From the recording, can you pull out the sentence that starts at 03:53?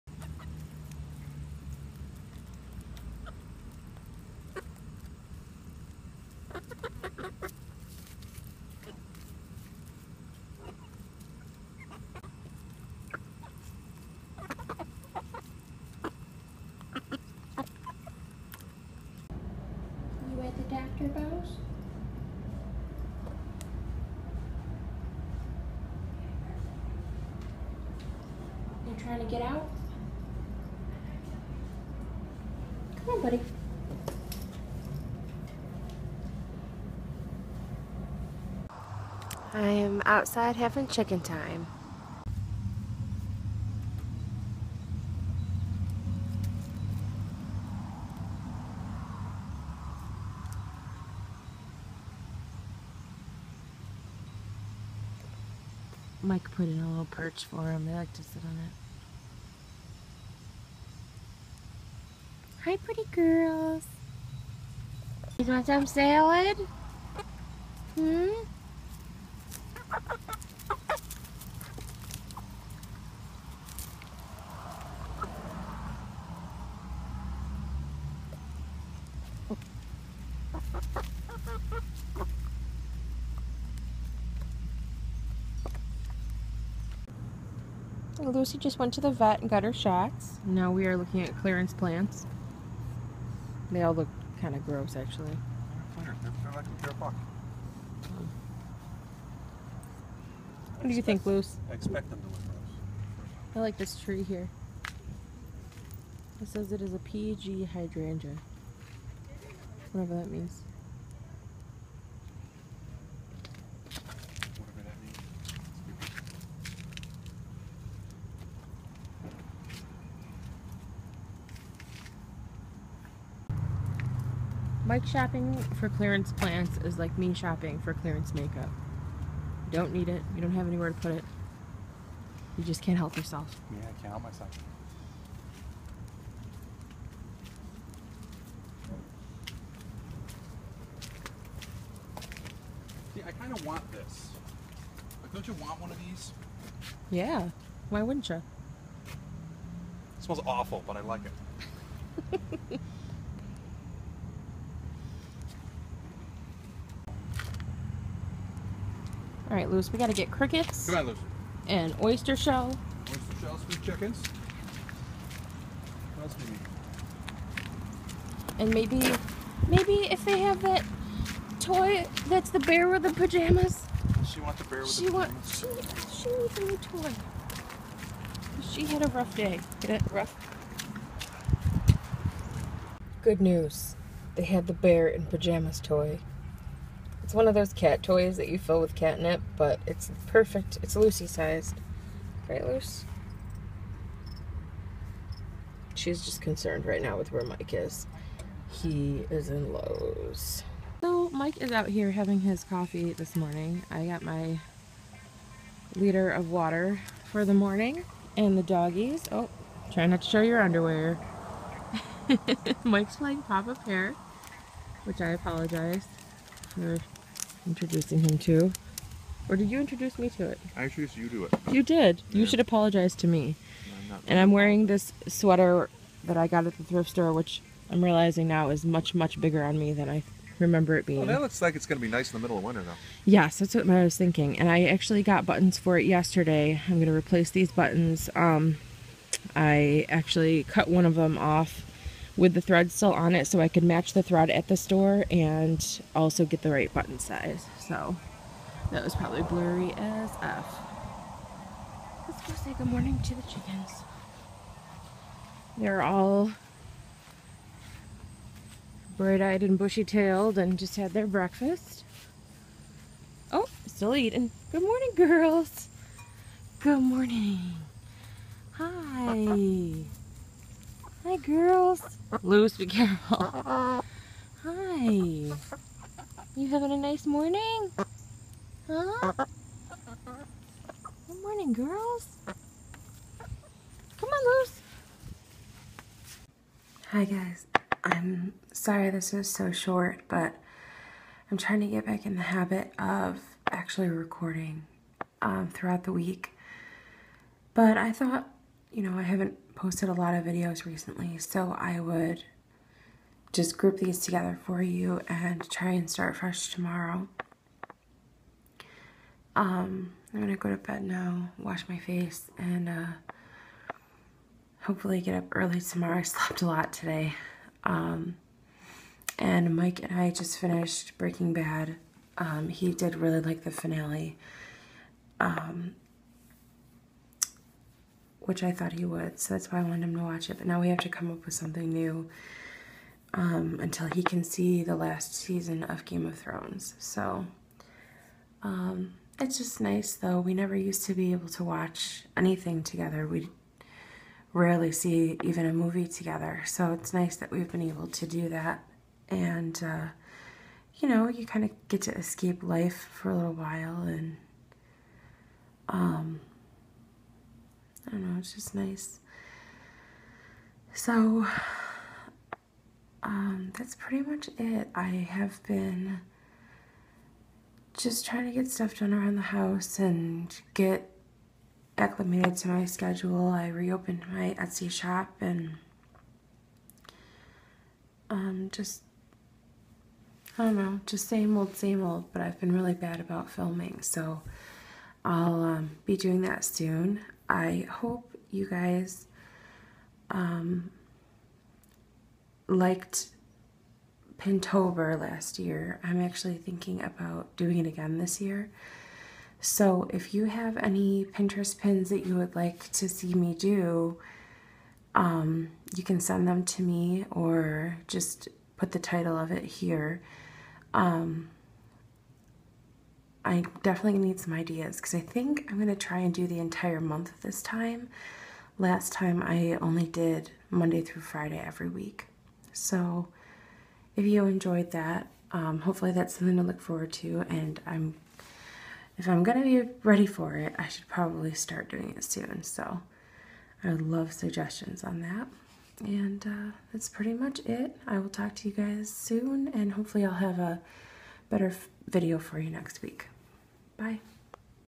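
Yes, that's what I was thinking.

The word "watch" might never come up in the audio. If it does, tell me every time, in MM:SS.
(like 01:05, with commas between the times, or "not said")
05:30, 05:41.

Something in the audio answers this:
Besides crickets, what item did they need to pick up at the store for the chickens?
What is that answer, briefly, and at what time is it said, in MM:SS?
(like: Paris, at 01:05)
Oyster shell, at 02:42.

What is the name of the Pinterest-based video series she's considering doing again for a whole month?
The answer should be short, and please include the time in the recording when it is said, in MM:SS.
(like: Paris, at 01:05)
Pintober, at 06:34.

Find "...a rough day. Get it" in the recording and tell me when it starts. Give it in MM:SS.
02:59.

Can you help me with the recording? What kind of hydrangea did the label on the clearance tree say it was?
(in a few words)
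PG hydrangea.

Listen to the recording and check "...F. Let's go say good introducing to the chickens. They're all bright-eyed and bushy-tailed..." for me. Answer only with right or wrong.
wrong.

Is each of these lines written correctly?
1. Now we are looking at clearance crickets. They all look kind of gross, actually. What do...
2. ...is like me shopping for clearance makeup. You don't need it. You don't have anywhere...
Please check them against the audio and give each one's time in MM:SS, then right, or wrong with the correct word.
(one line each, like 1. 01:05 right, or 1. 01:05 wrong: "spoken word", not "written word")
1. 01:30 wrong: "plants", not "crickets"
2. 02:06 right.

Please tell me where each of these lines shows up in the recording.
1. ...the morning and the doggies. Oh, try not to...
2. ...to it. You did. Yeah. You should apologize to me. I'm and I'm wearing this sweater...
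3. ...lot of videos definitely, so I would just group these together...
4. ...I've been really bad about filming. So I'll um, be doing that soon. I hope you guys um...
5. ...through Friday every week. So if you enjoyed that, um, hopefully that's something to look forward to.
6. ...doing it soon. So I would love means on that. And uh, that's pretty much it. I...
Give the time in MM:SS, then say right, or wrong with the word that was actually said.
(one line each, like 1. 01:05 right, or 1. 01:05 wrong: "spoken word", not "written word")
1. 03:27 right
2. 03:41 right
3. 05:00 wrong: "recently", not "definitely"
4. 06:22 right
5. 07:01 right
6. 07:11 wrong: "suggestions", not "means".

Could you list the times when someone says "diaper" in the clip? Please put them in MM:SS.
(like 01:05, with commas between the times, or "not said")
not said.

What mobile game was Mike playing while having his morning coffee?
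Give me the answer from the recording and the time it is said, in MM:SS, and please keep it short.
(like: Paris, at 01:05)
Papa Pear, at 03:33.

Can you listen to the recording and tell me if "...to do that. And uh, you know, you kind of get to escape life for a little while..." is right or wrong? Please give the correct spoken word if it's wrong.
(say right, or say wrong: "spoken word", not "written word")
right.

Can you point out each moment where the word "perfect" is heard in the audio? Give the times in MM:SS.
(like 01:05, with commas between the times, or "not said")
03:10.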